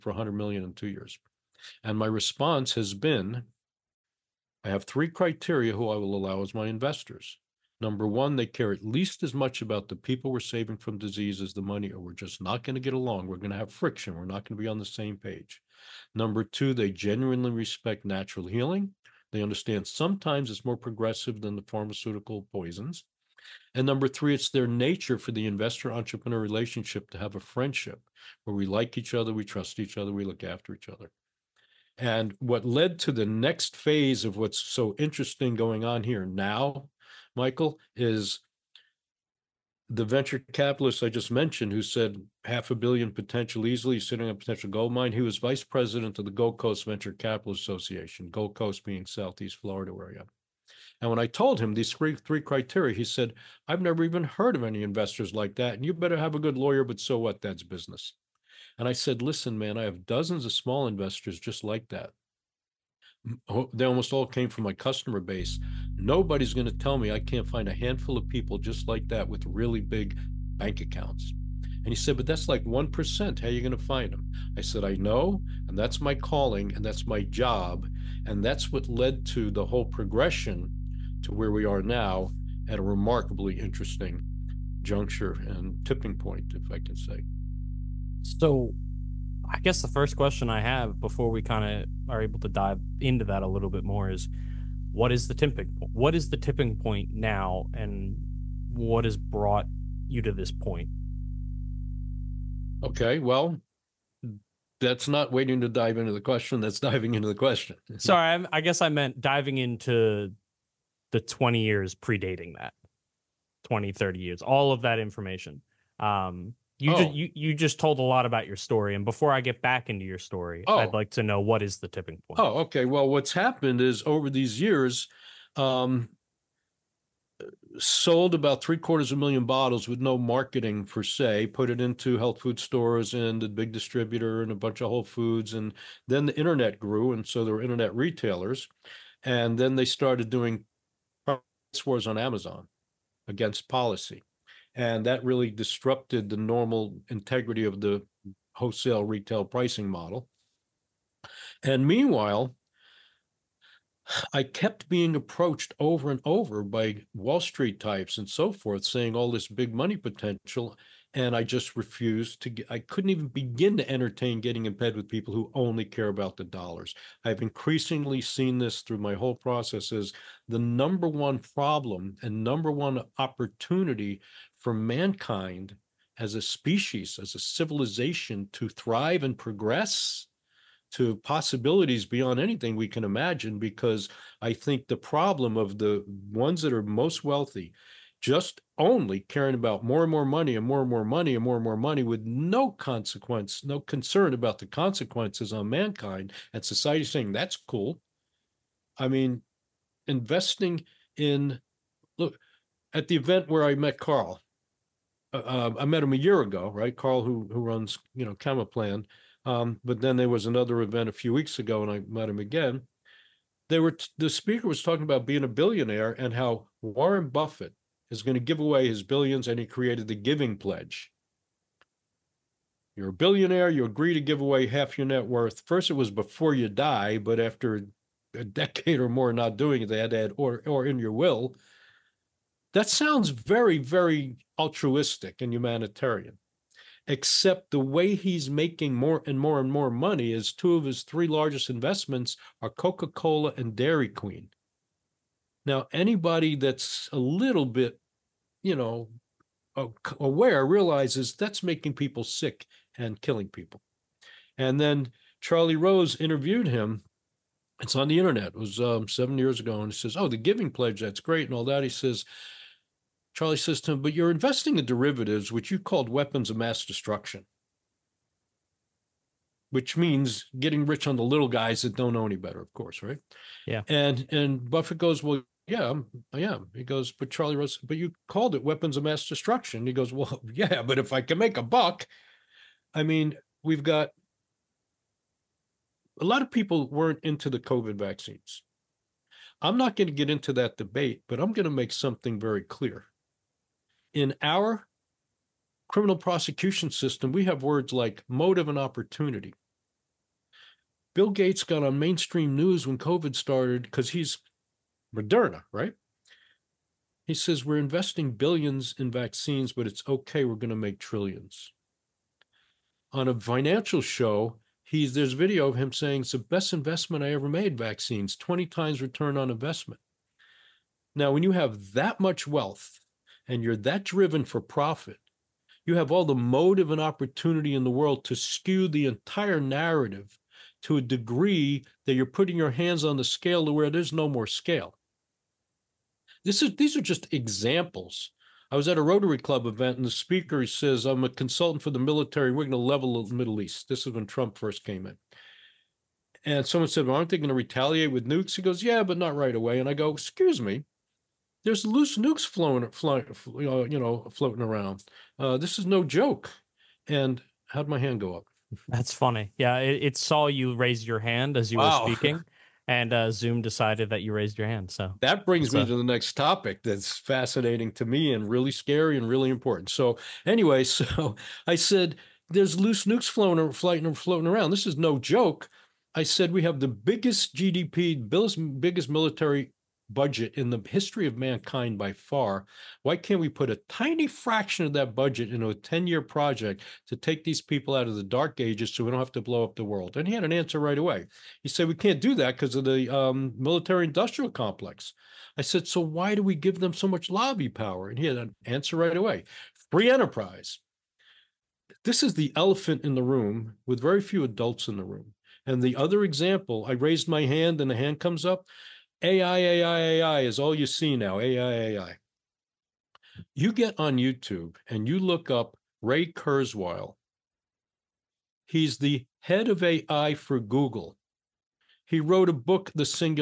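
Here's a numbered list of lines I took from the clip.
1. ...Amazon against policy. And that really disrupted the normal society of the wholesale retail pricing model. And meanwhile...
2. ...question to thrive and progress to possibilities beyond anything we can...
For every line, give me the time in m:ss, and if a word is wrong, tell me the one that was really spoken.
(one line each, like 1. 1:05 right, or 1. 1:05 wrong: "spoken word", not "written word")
1. 2:22 wrong: "integrity", not "society"
2. 2:57 wrong: "civilization", not "question".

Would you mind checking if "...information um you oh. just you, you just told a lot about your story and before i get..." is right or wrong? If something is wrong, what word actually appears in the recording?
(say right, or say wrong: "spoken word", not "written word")
right.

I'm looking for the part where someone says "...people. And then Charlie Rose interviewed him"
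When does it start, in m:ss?
4:13.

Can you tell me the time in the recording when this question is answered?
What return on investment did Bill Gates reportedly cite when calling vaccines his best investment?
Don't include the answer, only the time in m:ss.
5:18.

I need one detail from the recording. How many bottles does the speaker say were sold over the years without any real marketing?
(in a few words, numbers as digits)
three quarters of a million.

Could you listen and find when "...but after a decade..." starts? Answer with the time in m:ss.
3:47.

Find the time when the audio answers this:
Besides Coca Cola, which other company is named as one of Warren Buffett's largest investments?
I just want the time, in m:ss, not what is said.
4:03.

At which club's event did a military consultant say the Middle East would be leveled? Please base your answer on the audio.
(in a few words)
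Rotary Club.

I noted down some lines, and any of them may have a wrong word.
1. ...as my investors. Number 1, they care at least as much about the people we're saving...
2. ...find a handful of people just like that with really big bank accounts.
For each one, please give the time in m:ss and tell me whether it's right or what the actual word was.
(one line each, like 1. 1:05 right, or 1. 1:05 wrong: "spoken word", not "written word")
1. 0:06 right
2. 1:07 right.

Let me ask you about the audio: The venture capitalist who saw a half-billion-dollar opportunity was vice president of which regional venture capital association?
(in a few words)
Gold Coast Venture Capital Association.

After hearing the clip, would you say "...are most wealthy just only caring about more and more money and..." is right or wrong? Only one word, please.
right.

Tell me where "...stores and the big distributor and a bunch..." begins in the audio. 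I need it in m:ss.
2:12.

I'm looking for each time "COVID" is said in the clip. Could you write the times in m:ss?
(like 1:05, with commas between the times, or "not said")
4:47, 5:02.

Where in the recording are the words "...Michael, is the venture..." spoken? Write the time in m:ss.
0:37.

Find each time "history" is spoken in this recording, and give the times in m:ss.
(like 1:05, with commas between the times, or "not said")
6:20.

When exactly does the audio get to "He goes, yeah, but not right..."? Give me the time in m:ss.
5:48.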